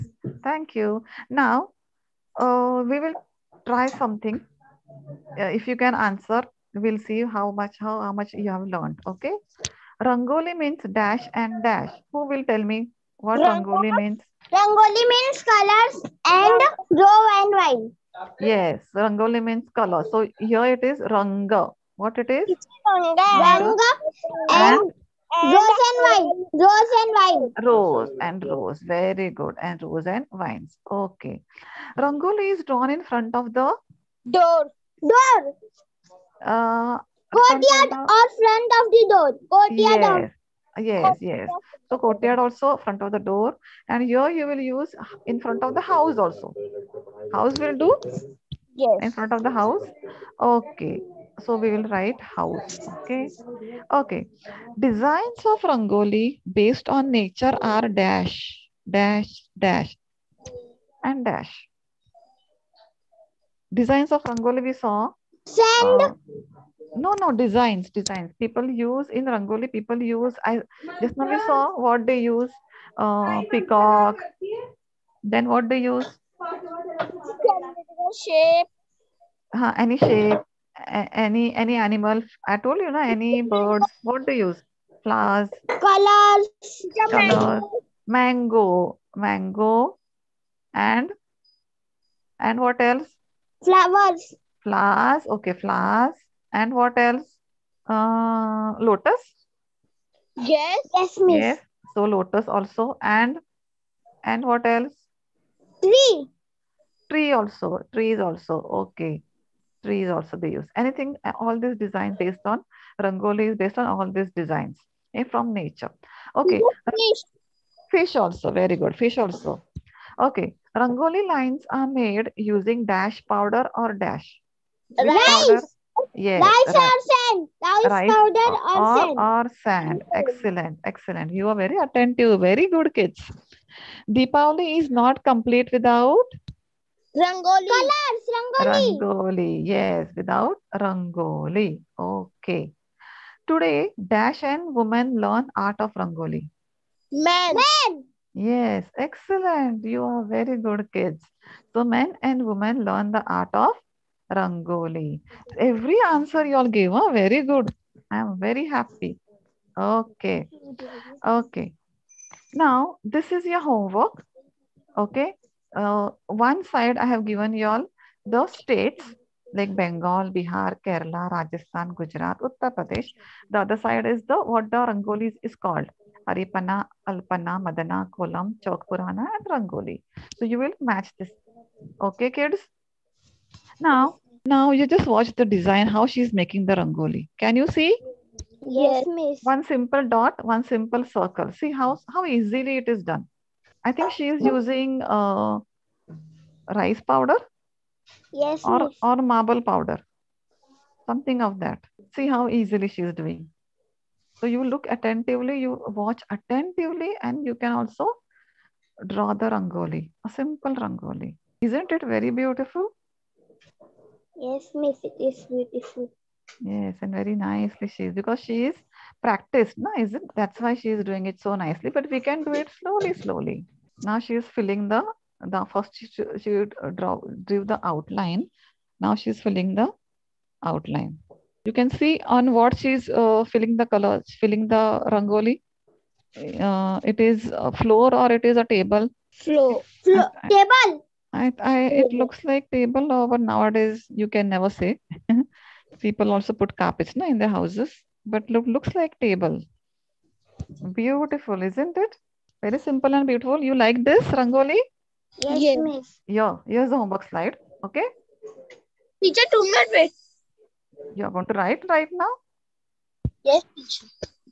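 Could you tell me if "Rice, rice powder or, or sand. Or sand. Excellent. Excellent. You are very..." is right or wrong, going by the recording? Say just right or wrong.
right.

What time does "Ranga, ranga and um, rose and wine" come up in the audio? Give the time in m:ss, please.
0:22.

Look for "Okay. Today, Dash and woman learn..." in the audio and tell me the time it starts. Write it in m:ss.
2:21.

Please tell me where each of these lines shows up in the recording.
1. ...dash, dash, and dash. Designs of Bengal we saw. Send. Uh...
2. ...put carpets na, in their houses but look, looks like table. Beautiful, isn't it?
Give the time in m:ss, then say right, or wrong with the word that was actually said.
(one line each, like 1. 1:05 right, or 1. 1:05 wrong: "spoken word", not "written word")
1. 0:58 wrong: "Rangoli", not "Bengal"
2. 4:06 right.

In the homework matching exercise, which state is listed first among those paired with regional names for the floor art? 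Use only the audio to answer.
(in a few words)
Bengal.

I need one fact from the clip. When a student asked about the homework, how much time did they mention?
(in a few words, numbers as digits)
Two minutes.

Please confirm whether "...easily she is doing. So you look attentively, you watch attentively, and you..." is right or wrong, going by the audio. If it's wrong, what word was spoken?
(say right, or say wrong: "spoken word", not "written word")
right.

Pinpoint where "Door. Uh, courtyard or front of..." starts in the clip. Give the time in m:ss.
0:34.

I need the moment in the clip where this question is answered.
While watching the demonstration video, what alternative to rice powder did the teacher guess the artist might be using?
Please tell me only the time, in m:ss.
3:19.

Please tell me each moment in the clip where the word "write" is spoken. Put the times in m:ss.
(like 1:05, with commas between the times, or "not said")
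0:51, 4:21.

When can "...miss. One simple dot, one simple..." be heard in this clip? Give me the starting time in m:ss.
3:09.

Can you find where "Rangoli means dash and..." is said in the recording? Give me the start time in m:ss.
0:10.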